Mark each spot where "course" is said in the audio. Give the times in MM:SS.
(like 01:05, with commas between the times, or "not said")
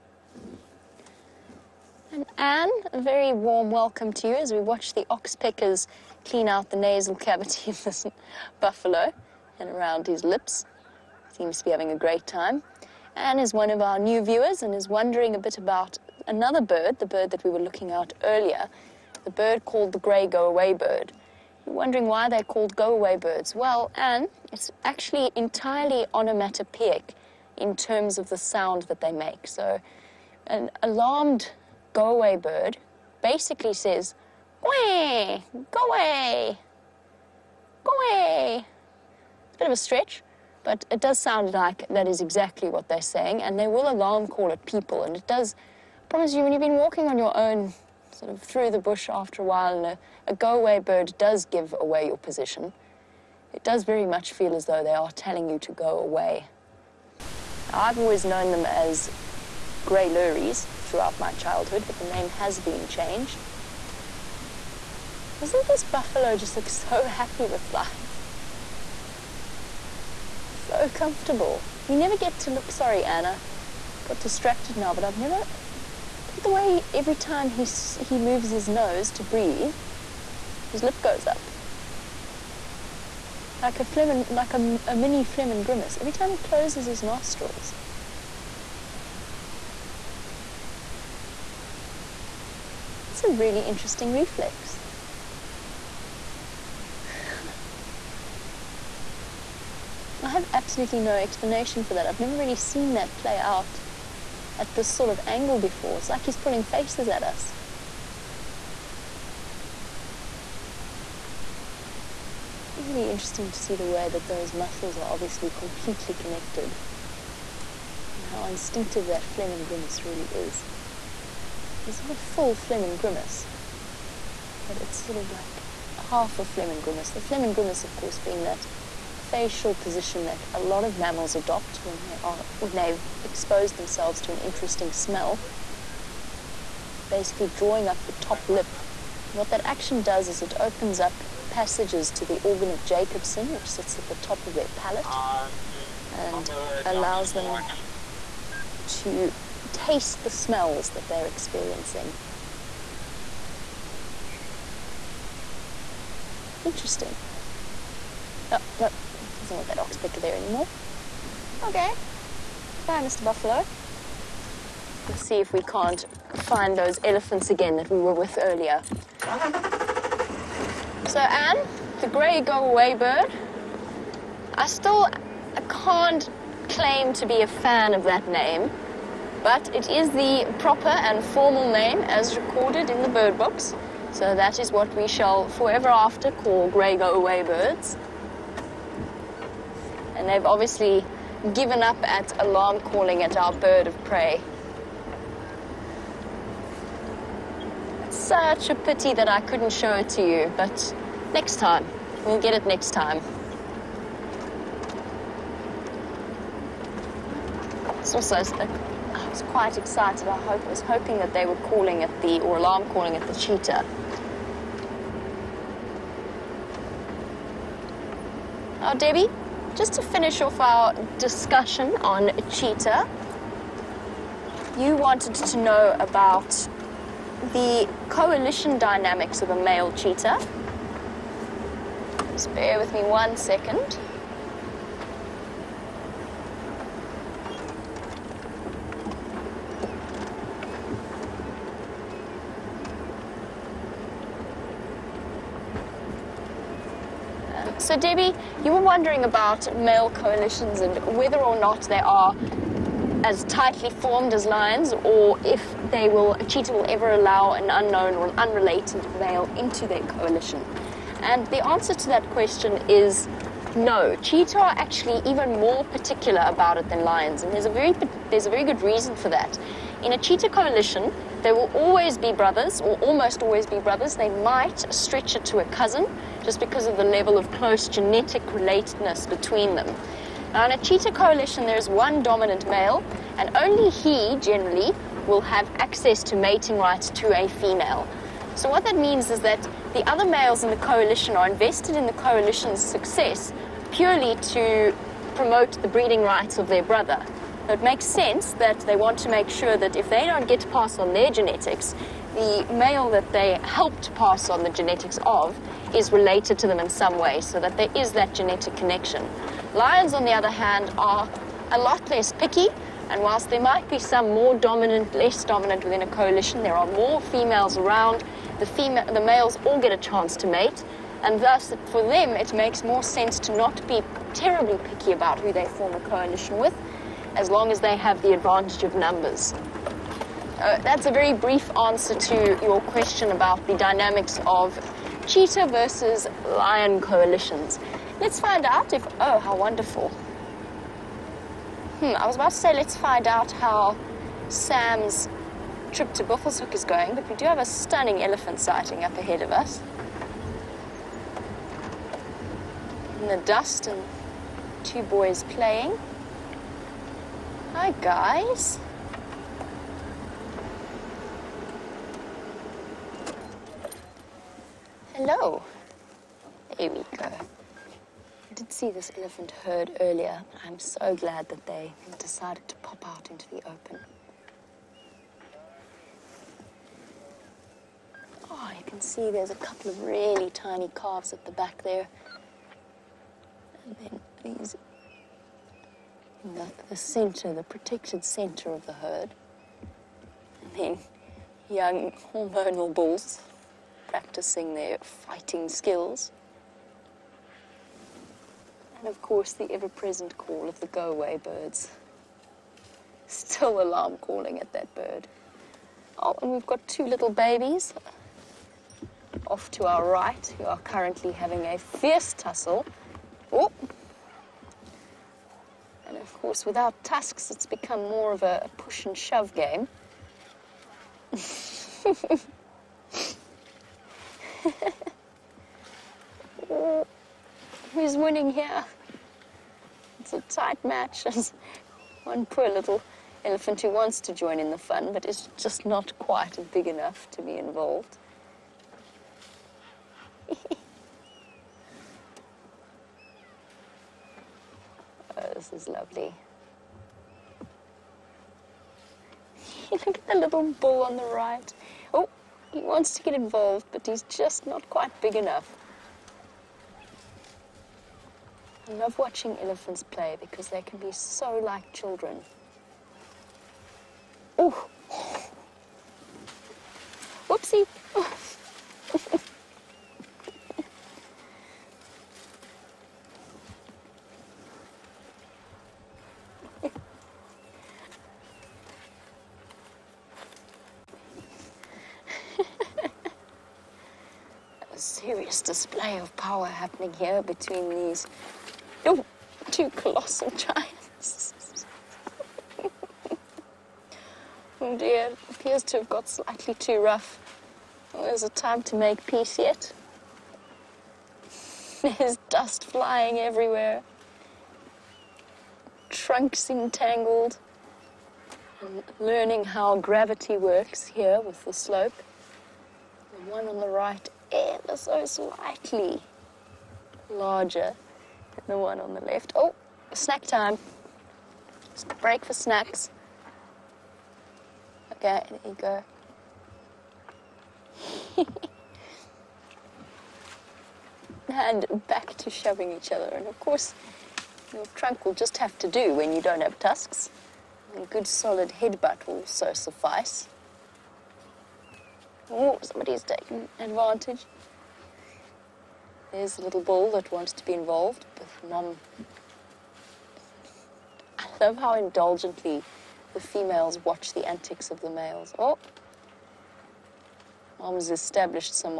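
02:07, 06:39, 06:56, 08:53.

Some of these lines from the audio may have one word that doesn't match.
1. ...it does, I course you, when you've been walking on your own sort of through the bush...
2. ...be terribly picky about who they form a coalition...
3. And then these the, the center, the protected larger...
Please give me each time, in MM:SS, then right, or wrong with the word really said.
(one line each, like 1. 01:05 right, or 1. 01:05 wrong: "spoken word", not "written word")
1. 00:45 wrong: "promise", not "course"
2. 05:23 right
3. 06:23 wrong: "center", not "larger".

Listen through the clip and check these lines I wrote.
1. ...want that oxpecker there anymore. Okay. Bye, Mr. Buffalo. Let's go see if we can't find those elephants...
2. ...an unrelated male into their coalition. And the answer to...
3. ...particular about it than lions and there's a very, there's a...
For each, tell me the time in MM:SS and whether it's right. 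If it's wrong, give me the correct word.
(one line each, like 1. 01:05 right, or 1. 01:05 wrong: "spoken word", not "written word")
1. 02:39 right
2. 04:18 right
3. 04:25 right.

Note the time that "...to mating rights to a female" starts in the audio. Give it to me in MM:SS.
04:46.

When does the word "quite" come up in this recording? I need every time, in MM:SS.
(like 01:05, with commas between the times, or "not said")
03:29, 07:16, 07:34.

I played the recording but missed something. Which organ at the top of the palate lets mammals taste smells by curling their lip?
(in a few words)
Organ of Jacobson.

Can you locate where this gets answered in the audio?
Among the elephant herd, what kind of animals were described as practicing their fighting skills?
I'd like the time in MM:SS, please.
06:31.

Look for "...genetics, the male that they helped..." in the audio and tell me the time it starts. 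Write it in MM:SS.
05:01.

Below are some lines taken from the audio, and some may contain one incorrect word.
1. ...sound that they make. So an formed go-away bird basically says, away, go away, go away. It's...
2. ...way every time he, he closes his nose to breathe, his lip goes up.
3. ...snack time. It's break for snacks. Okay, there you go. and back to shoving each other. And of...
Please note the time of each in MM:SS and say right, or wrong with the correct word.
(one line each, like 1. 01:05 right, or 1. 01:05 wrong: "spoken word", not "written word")
1. 00:28 wrong: "alarmed", not "formed"
2. 01:16 wrong: "moves", not "closes"
3. 08:40 right.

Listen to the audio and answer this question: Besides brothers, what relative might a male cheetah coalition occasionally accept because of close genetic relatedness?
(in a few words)
A cousin.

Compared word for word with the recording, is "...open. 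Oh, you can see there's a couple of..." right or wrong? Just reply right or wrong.
right.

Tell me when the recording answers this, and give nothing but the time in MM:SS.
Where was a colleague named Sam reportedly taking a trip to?
05:46.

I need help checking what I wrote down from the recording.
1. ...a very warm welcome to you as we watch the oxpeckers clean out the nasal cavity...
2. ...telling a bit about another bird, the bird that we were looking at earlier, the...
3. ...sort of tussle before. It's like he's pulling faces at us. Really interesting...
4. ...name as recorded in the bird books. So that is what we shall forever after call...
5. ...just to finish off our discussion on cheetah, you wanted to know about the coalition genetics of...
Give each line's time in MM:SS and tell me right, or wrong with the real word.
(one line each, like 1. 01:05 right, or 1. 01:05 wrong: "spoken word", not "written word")
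1. 00:02 right
2. 00:14 wrong: "wondering", not "telling"
3. 01:44 wrong: "angle", not "tussle"
4. 03:01 right
5. 03:39 wrong: "dynamics", not "genetics".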